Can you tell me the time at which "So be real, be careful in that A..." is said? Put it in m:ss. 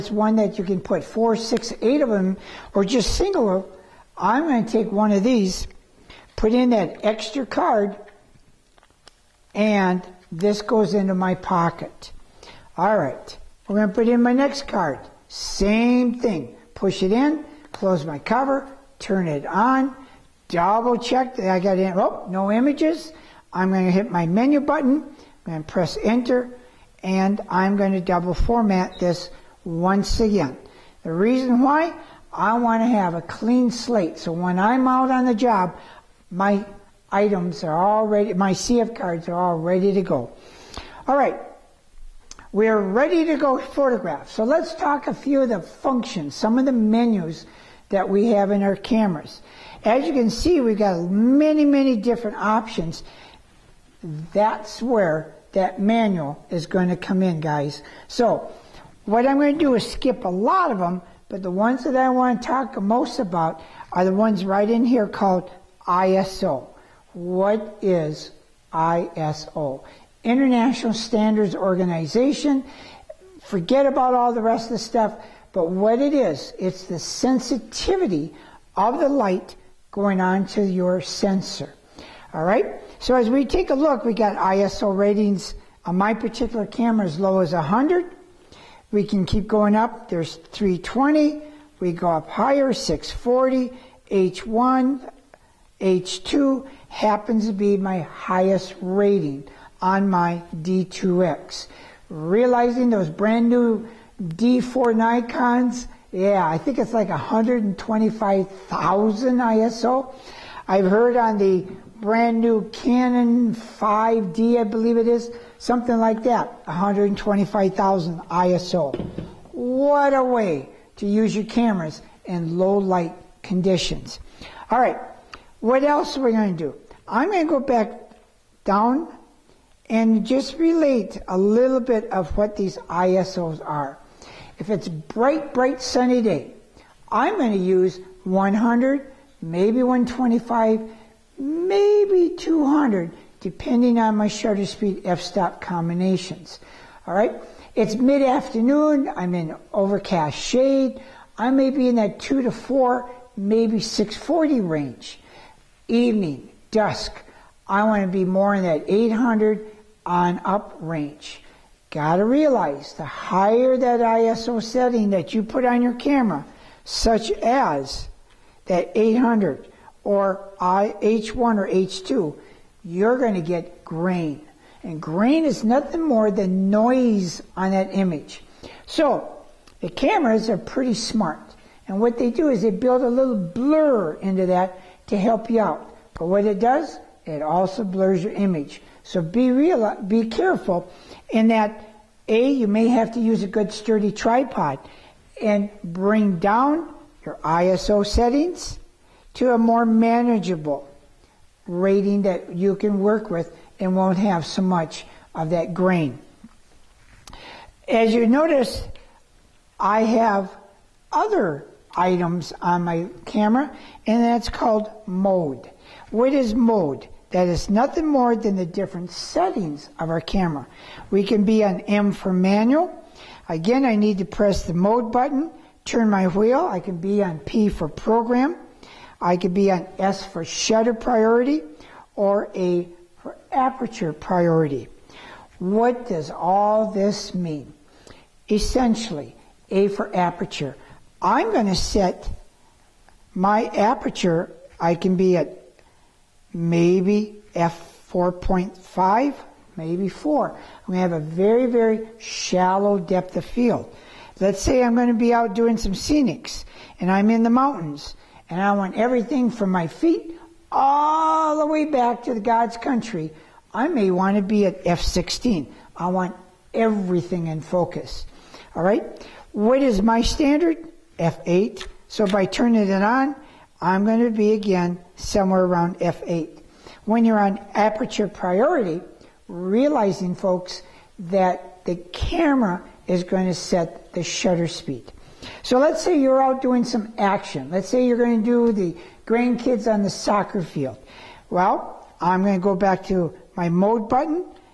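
3:09.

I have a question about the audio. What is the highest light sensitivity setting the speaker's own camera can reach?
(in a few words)
H2.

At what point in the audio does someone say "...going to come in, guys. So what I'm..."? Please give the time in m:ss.
0:56.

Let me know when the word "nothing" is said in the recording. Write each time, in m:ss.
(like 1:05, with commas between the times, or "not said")
2:55, 3:37.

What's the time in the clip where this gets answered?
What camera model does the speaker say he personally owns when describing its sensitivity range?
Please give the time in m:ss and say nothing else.
1:40.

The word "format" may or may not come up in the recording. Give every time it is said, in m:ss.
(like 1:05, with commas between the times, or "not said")
0:28.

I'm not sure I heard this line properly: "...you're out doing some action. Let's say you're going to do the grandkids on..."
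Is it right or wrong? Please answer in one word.
right.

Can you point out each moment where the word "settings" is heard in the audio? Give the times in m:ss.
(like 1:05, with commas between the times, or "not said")
2:44, 3:18, 3:39.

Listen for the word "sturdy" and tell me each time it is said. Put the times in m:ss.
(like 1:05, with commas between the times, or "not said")
3:13.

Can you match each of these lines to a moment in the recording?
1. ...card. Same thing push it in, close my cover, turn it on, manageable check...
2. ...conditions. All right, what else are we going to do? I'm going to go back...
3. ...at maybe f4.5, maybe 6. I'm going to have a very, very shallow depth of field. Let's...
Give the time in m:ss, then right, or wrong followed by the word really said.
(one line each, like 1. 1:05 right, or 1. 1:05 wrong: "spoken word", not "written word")
1. 0:14 wrong: "double", not "manageable"
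2. 2:03 right
3. 4:05 wrong: "4", not "6".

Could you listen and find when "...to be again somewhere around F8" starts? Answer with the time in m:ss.
4:34.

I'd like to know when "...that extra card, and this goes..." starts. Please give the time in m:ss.
0:06.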